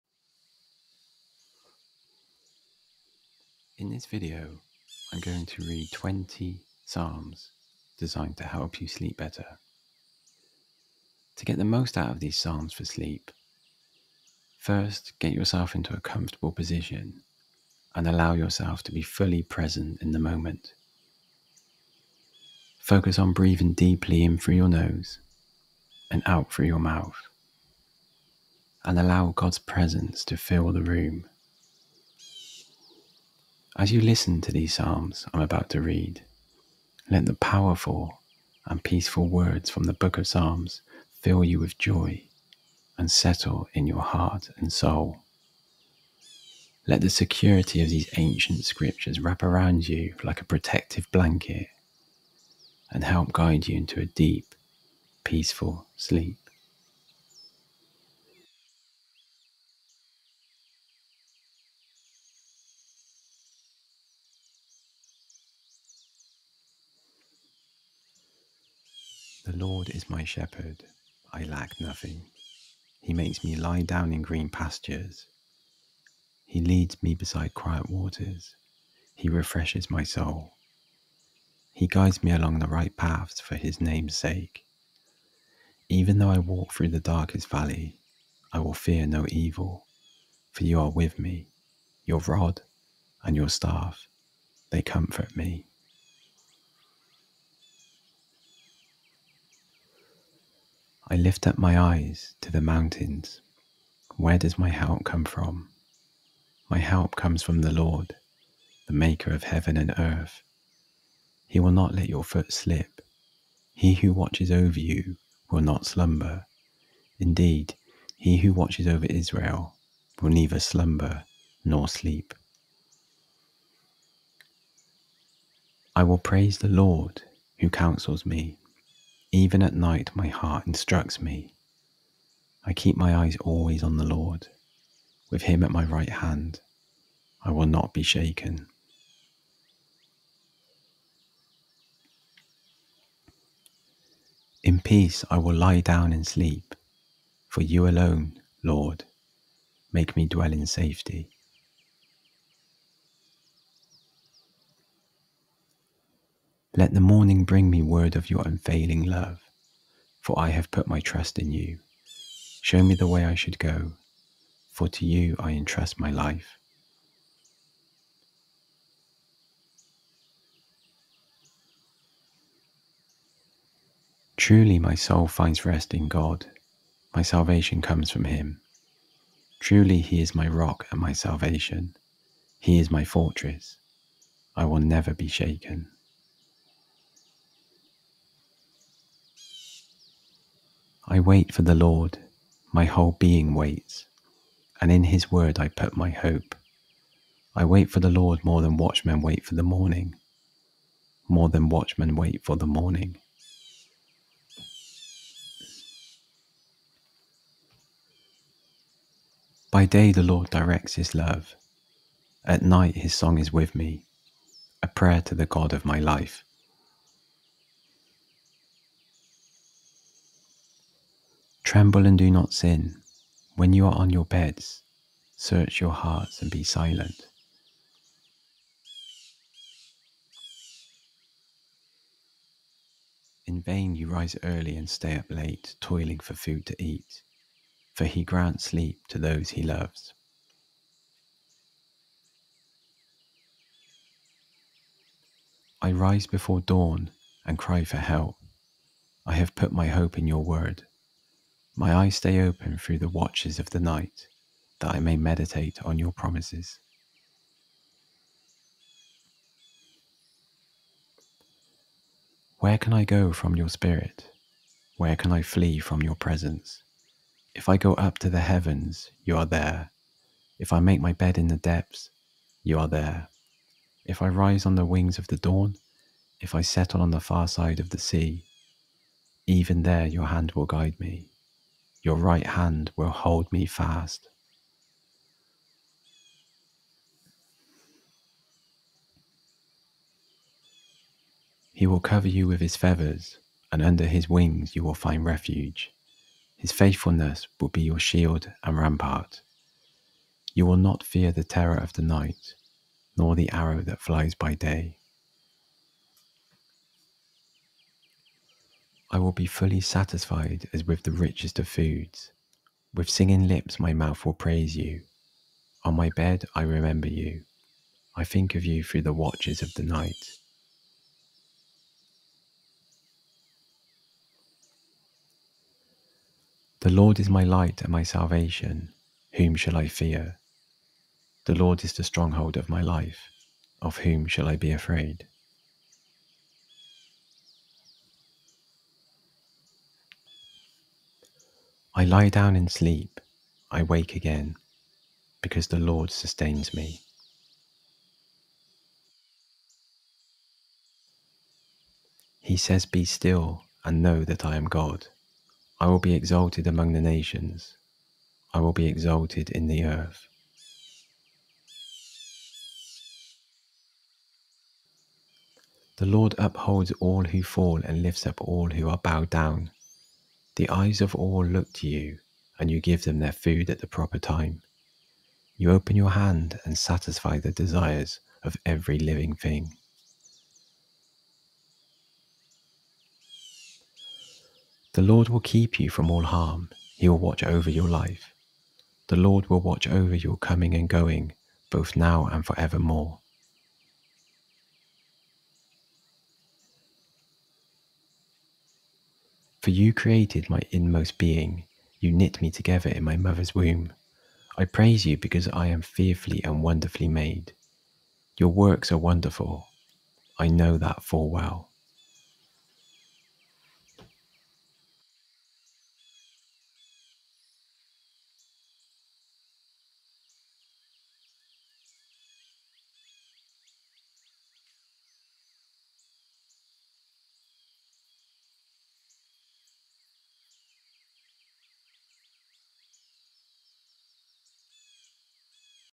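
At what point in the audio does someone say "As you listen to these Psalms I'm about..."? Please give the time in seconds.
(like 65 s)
33 s.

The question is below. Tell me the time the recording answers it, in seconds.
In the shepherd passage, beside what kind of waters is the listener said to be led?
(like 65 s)
77 s.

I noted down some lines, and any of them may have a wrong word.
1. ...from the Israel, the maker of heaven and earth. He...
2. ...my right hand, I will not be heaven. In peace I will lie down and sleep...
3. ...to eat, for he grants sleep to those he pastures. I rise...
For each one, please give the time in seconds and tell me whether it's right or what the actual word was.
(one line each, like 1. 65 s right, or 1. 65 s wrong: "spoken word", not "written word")
1. 107 s wrong: "Lord", not "Israel"
2. 135 s wrong: "shaken", not "heaven"
3. 236 s wrong: "loves", not "pastures".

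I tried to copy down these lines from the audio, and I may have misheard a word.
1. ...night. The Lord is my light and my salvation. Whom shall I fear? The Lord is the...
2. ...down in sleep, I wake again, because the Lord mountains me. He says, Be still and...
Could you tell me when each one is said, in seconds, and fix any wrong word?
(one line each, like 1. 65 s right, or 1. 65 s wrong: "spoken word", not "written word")
1. 319 s right
2. 342 s wrong: "sustains", not "mountains".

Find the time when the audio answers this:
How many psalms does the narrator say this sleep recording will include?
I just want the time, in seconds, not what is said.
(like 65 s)
5 s.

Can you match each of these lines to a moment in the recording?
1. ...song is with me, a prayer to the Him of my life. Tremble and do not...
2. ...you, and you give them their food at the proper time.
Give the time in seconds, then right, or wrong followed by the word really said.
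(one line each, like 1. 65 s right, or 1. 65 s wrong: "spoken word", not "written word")
1. 213 s wrong: "God", not "Him"
2. 371 s right.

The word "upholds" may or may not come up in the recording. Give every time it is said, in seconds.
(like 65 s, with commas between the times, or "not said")
366 s.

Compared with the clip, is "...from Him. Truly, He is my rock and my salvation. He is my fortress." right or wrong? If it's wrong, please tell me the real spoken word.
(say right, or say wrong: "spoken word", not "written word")
right.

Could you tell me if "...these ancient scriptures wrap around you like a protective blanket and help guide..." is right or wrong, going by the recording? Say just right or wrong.
right.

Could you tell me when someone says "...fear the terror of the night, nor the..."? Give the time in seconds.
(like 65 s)
301 s.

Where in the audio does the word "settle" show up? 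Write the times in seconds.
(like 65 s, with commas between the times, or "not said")
43 s, 276 s.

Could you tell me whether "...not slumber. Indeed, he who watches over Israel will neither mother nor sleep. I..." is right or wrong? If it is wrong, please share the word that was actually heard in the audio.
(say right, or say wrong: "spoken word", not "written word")
wrong: "slumber", not "mother".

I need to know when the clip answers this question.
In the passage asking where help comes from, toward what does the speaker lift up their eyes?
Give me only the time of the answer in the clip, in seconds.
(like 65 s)
102 s.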